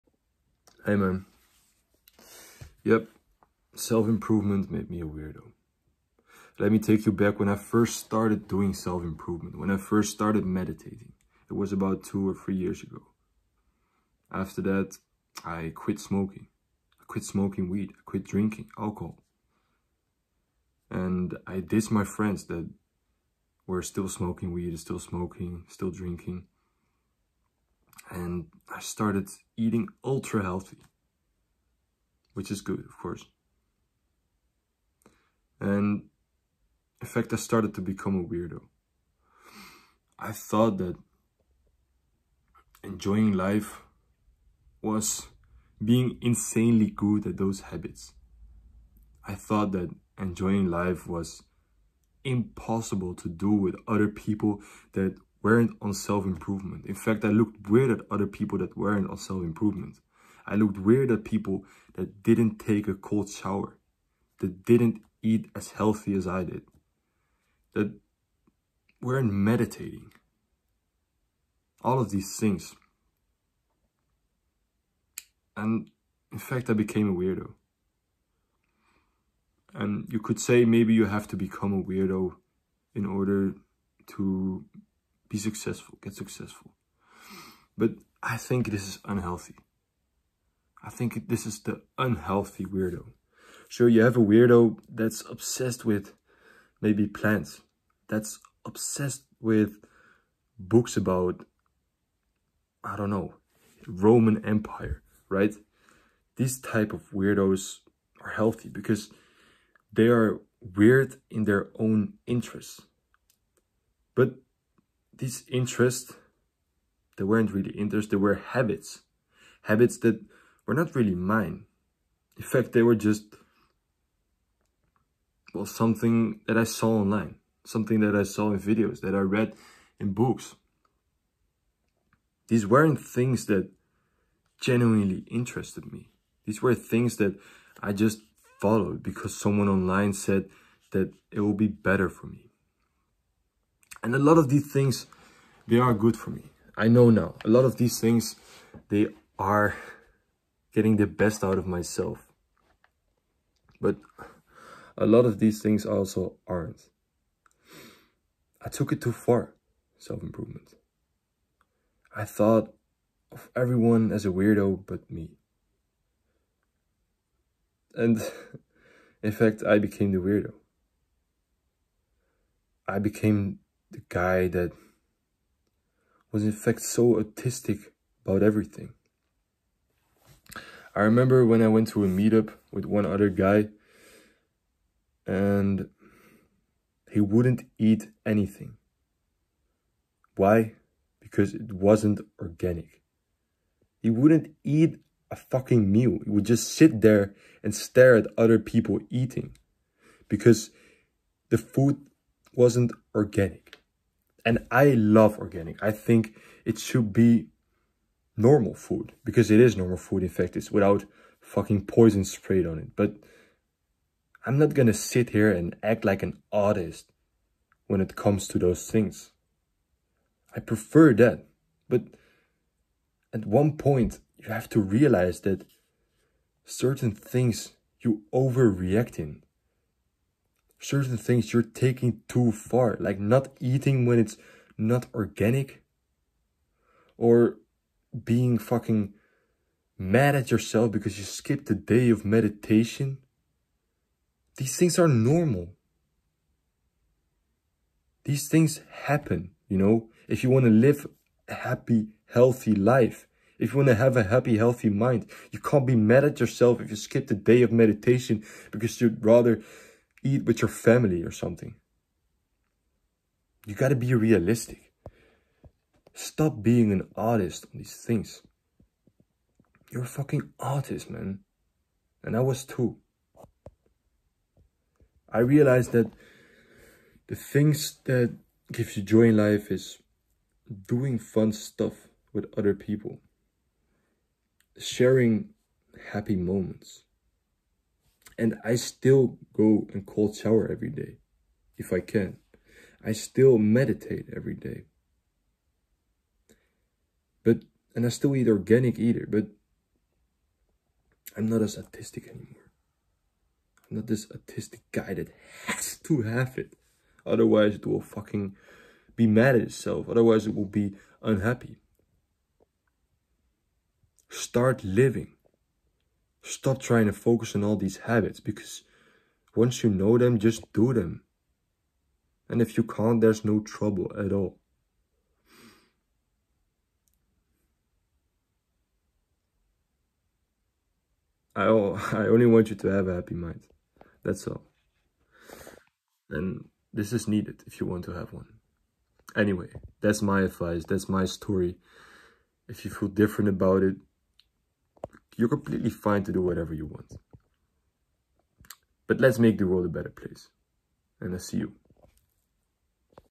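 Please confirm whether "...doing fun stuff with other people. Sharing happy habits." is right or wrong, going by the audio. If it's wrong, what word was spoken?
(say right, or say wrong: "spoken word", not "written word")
wrong: "moments", not "habits".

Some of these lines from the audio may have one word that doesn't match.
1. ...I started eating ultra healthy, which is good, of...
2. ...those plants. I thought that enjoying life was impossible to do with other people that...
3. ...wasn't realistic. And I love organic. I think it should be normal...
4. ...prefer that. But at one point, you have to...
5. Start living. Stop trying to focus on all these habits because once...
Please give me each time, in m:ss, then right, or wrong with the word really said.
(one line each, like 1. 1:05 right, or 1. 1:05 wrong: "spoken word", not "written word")
1. 0:28 right
2. 0:47 wrong: "habits", not "plants"
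3. 3:22 wrong: "organic", not "realistic"
4. 3:40 right
5. 5:14 right.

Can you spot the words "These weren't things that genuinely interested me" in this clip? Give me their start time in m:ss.
2:12.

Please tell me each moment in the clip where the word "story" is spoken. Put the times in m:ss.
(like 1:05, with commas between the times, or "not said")
5:41.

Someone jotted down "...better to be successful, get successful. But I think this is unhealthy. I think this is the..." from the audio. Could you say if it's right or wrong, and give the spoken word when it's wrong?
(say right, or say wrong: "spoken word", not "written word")
wrong: "order", not "better".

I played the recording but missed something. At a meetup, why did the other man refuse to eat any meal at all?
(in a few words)
It wasn't organic.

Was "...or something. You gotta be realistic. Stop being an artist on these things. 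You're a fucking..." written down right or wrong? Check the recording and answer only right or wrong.
right.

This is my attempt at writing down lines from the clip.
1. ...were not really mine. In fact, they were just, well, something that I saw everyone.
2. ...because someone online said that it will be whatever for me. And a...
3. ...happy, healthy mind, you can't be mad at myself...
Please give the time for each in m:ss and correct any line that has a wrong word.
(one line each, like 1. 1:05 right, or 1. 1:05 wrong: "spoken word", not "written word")
1. 2:00 wrong: "online", not "everyone"
2. 2:19 wrong: "better", not "whatever"
3. 4:14 wrong: "yourself", not "myself".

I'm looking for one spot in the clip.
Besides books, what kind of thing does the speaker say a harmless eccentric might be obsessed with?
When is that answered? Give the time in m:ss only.
1:37.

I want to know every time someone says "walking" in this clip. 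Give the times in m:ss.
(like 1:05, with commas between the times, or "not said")
not said.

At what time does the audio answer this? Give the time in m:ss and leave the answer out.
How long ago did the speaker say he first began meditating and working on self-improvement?
0:12.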